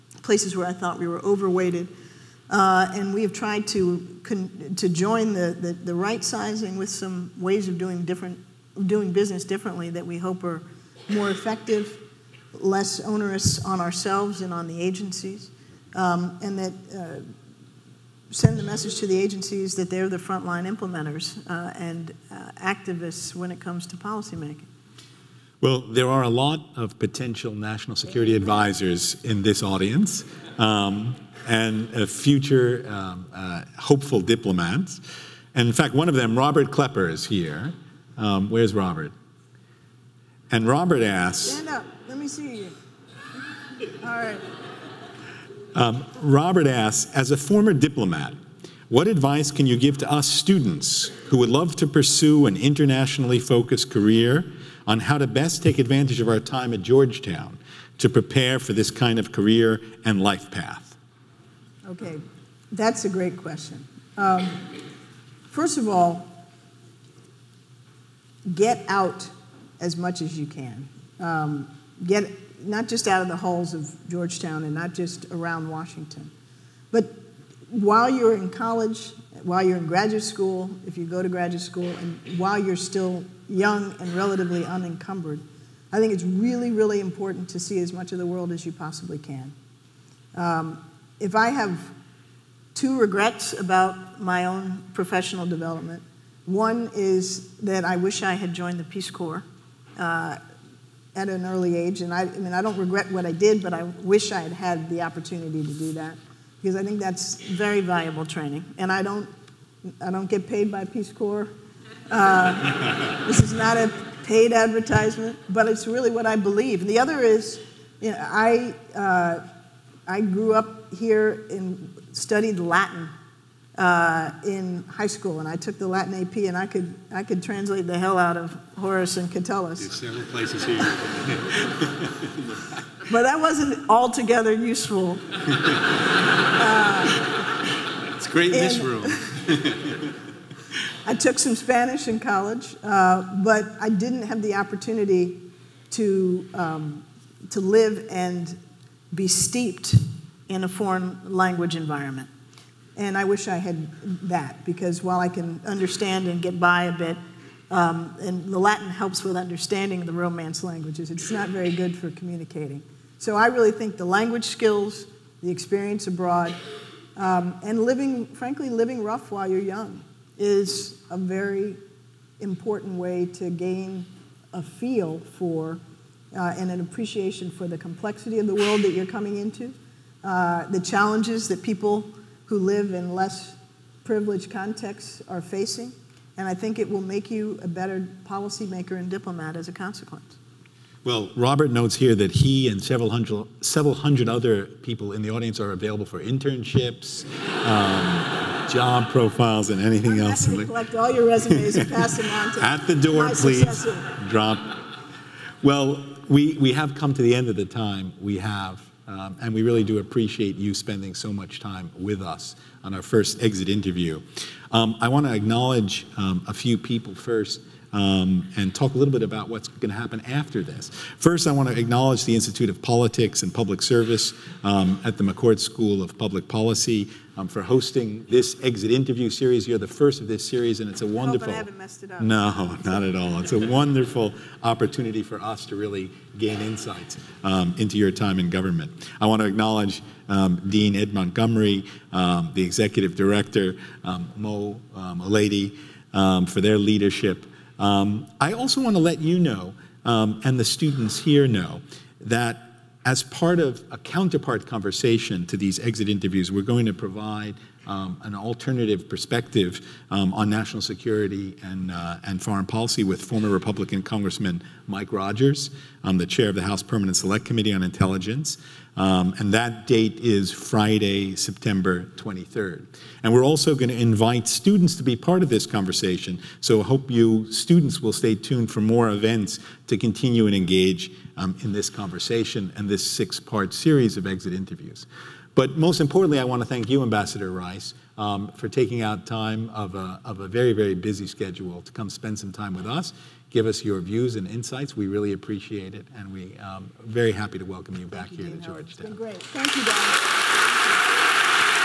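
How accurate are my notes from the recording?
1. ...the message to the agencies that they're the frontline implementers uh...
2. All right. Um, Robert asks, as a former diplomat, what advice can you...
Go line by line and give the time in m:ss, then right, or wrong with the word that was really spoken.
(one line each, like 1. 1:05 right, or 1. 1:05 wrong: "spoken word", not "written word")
1. 0:18 right
2. 0:44 right.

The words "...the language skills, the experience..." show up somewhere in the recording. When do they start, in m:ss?
2:43.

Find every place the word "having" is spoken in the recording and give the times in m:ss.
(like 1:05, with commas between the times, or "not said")
not said.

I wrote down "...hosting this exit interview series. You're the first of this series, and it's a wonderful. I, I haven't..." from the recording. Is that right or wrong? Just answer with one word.
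right.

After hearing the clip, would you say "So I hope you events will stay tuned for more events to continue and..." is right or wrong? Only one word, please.
wrong.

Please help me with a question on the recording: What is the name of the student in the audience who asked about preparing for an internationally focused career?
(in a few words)
Robert Klepper.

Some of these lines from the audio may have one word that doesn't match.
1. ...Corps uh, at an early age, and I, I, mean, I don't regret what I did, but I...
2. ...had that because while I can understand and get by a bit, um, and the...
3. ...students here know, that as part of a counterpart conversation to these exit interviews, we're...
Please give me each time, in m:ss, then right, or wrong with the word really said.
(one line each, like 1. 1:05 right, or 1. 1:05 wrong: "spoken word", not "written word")
1. 1:39 right
2. 2:33 right
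3. 4:10 right.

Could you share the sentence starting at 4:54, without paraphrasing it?
We really appreciate it, and we're um, very happy to welcome you back thank here you, to Georgetown.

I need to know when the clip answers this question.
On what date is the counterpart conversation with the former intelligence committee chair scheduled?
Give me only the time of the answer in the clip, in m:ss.
4:30.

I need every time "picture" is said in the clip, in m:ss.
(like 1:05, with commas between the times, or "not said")
not said.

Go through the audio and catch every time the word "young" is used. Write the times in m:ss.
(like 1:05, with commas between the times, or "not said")
1:23, 2:49.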